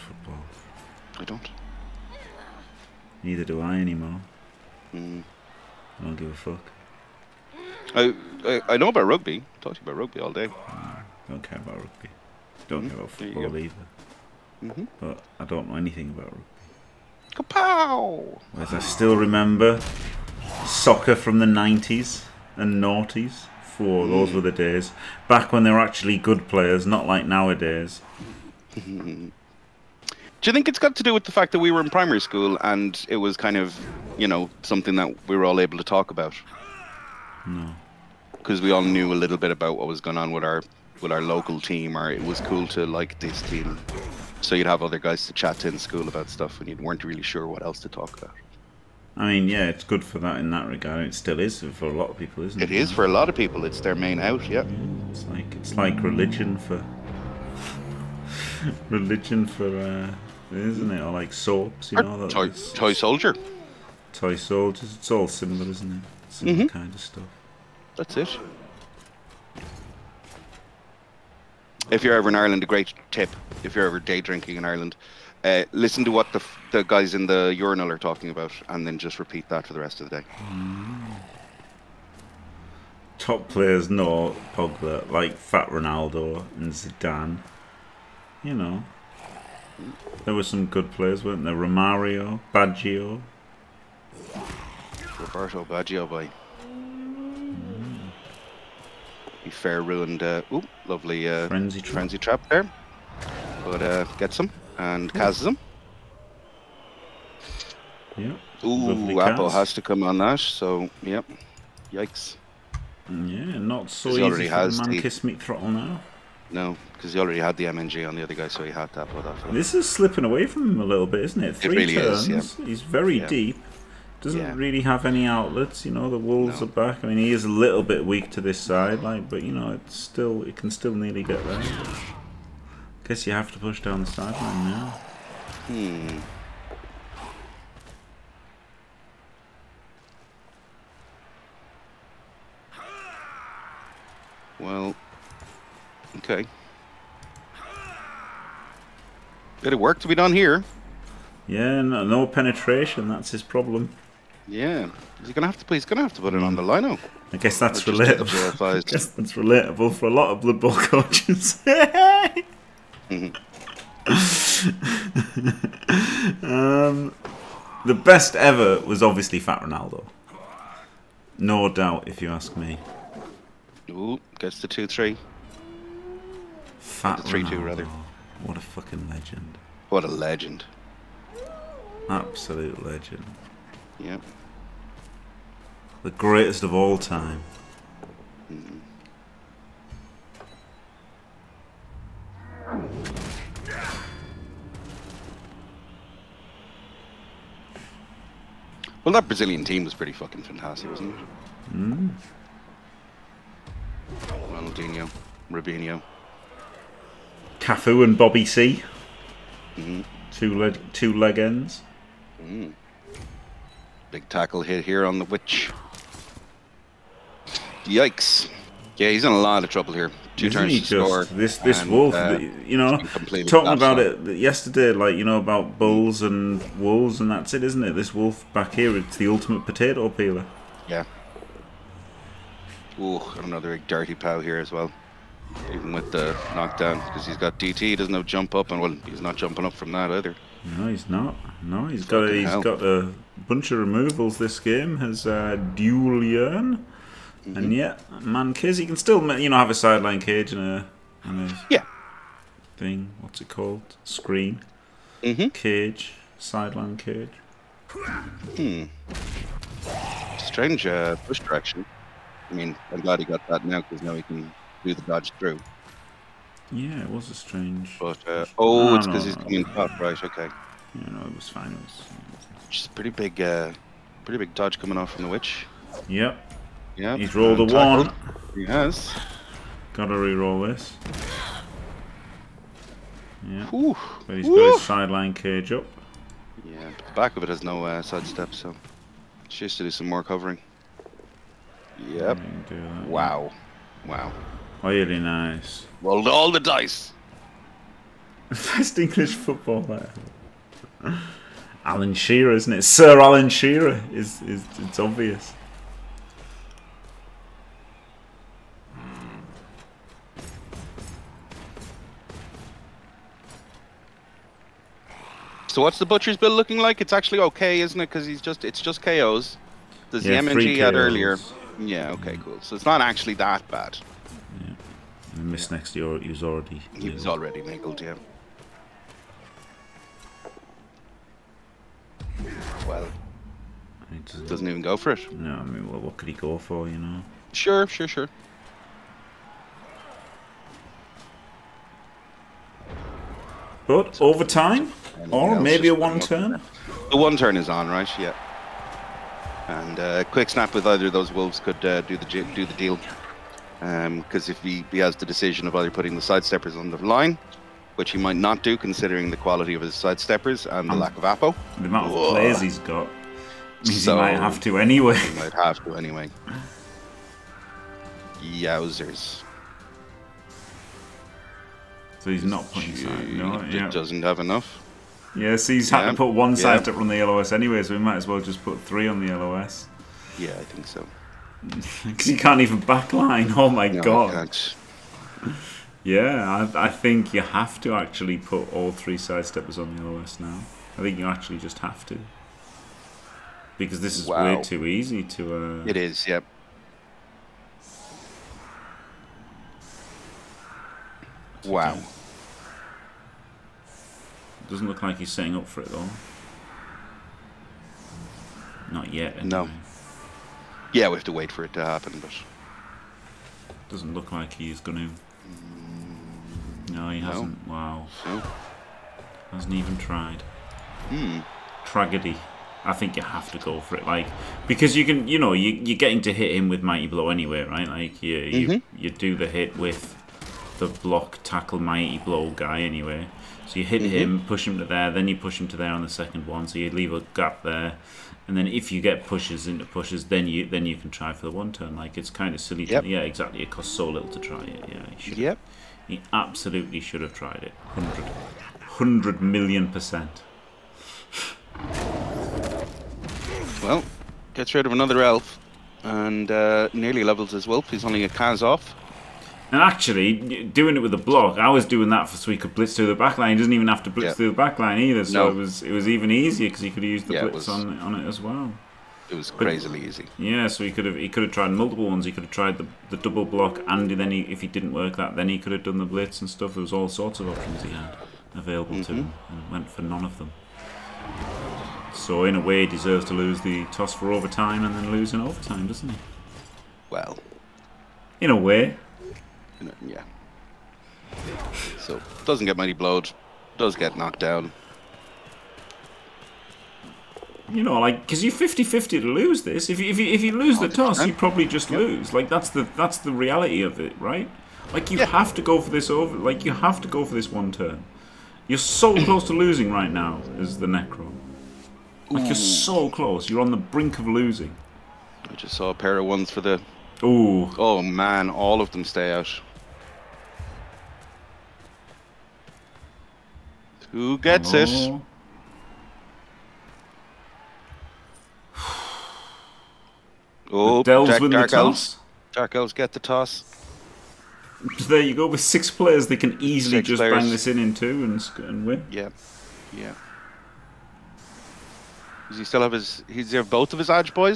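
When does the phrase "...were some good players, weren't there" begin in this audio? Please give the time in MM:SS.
01:30.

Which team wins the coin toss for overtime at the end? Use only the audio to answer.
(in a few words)
Dark Elves.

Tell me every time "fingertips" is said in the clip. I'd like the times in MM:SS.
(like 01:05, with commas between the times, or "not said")
not said.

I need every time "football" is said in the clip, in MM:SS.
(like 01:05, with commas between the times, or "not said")
00:13, 04:59.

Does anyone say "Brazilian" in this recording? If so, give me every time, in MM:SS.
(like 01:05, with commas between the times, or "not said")
03:19.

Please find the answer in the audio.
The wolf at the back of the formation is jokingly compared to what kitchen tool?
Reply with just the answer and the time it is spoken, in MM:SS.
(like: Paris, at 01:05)
potato peeler, at 03:49.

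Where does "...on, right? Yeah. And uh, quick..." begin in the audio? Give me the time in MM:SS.
05:47.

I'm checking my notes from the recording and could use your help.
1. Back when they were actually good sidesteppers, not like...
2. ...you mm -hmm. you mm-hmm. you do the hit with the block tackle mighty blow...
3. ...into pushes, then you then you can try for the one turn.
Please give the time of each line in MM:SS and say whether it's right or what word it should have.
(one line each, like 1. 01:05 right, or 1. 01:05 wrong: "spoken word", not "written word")
1. 00:25 wrong: "players", not "sidesteppers"
2. 07:08 right
3. 07:19 right.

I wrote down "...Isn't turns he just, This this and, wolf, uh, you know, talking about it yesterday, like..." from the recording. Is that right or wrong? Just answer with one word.
right.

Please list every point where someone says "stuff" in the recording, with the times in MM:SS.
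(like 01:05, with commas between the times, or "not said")
00:46, 01:07, 07:56.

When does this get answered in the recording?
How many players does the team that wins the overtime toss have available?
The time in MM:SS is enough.
08:55.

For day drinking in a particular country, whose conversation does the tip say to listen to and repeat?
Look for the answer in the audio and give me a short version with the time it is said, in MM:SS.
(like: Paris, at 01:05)
the guys in the urinal, at 01:16.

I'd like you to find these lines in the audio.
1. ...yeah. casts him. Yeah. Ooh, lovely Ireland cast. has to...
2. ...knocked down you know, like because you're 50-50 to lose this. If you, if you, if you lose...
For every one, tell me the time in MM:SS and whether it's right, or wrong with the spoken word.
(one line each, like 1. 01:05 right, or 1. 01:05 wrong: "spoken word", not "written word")
1. 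01:45 wrong: "Apple", not "Ireland"
2. 08:14 right.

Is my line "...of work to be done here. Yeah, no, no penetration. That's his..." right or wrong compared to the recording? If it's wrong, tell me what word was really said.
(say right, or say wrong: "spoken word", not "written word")
right.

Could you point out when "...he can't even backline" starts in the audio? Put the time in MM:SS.
06:22.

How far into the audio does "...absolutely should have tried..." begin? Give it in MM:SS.
07:26.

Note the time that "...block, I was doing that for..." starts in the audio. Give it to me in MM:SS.
07:41.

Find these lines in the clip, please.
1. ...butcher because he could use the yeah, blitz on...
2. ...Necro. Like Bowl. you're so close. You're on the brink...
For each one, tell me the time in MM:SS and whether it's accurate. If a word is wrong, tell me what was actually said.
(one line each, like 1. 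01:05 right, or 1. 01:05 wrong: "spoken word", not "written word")
1. 07:46 wrong: "easier", not "butcher"
2. 08:30 wrong: "Ooh", not "Bowl".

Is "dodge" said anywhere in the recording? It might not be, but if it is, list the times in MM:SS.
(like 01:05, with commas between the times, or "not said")
04:25, 04:34.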